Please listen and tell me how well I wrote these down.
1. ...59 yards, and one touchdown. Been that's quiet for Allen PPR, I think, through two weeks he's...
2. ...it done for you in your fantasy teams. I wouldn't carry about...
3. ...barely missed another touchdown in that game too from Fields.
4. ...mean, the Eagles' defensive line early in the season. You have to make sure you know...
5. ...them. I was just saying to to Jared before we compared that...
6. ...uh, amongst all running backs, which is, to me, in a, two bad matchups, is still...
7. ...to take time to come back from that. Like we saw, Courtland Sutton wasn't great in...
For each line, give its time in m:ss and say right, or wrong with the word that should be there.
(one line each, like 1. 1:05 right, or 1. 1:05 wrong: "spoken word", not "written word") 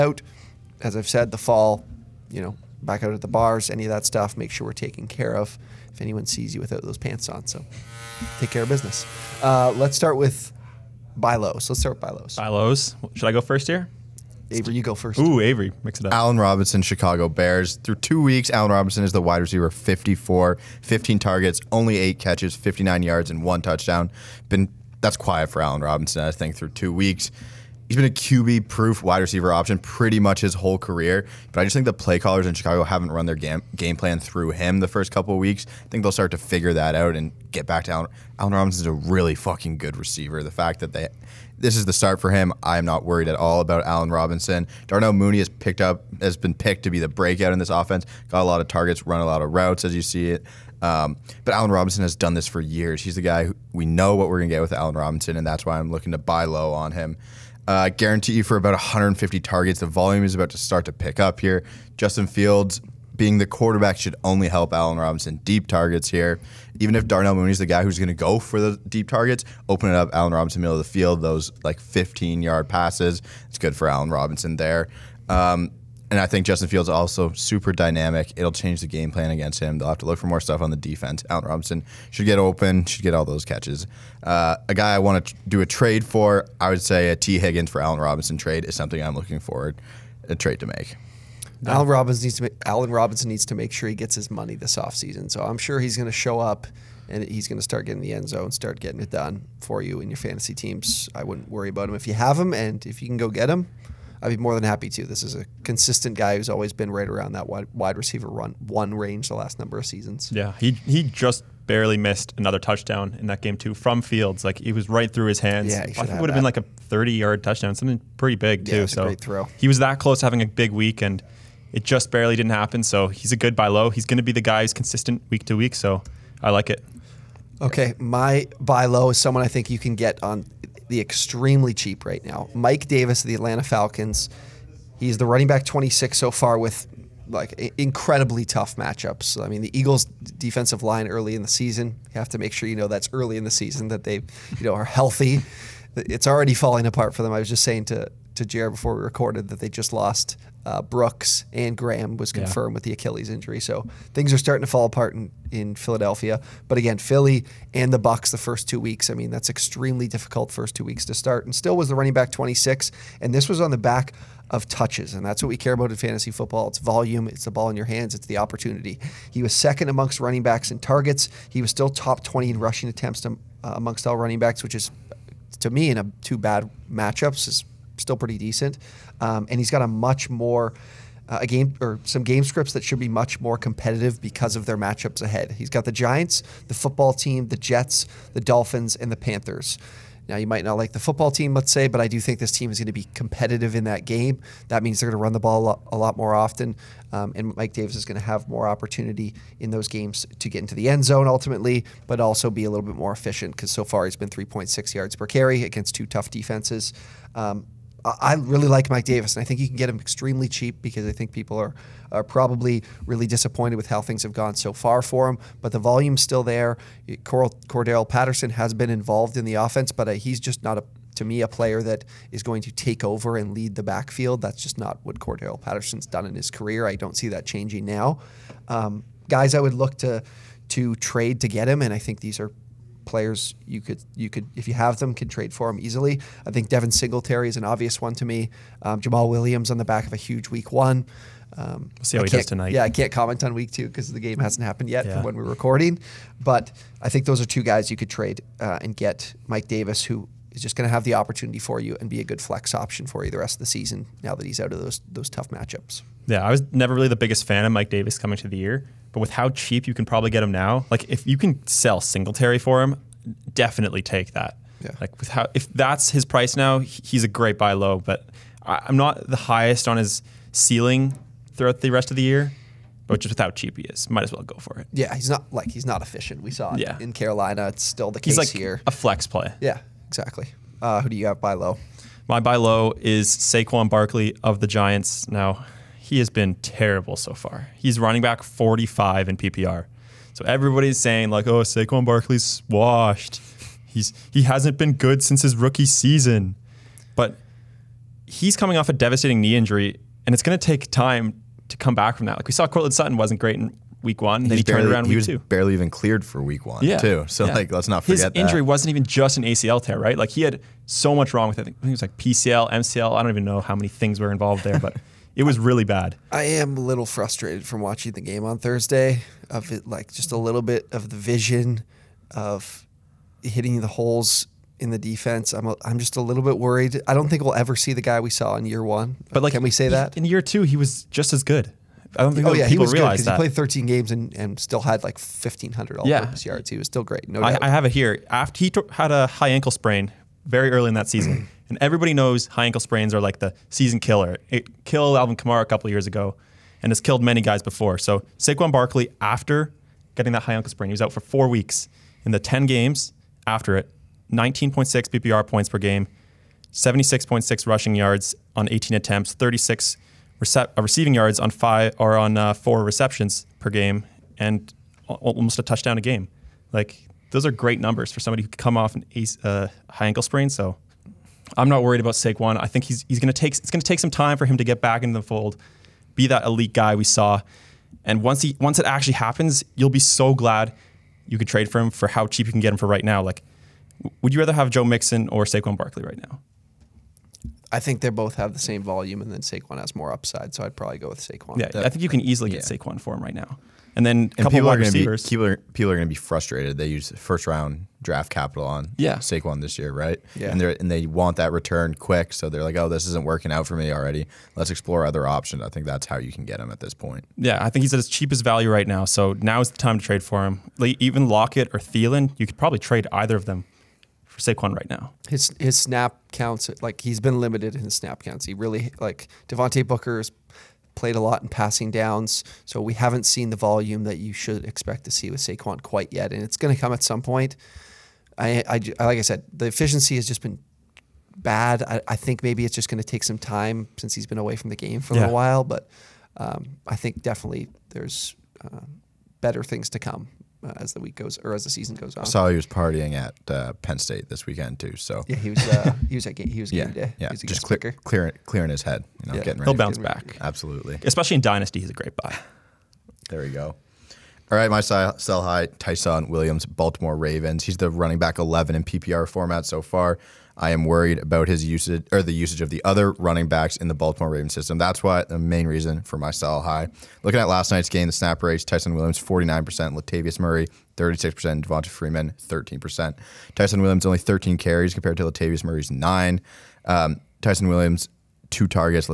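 1. 0:22 wrong: "Robinson", not "PPR"
2. 1:38 wrong: "worry", not "carry"
3. 1:51 right
4. 2:19 right
5. 2:27 wrong: "recorded", not "compared"
6. 2:53 right
7. 5:00 right.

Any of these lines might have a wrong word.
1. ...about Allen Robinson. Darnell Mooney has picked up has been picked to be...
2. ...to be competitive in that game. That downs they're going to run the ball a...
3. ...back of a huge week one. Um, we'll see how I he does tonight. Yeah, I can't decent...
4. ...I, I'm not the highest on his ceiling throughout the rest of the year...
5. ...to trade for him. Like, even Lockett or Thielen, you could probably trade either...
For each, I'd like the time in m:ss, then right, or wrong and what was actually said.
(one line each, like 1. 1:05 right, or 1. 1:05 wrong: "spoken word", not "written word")
1. 0:43 right
2. 3:12 wrong: "means", not "downs"
3. 3:59 wrong: "comment", not "decent"
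4. 4:28 right
5. 6:49 right.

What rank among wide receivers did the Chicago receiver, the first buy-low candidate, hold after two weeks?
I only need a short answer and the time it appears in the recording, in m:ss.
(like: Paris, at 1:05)
54, at 0:19.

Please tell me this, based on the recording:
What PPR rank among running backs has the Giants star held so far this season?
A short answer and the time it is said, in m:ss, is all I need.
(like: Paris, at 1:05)
45, at 4:47.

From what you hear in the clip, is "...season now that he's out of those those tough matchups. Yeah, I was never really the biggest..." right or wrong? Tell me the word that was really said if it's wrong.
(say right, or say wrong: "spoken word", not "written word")
right.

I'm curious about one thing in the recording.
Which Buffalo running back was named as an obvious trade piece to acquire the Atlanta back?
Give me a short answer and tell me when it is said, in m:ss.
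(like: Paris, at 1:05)
Devin Singletary, at 3:56.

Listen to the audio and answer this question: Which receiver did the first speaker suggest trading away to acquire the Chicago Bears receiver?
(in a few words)
Tee Higgins.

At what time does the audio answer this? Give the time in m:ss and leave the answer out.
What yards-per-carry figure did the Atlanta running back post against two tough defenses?
3:24.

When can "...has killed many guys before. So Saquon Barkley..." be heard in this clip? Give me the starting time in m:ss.
5:46.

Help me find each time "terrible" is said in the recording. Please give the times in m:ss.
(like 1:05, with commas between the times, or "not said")
4:46.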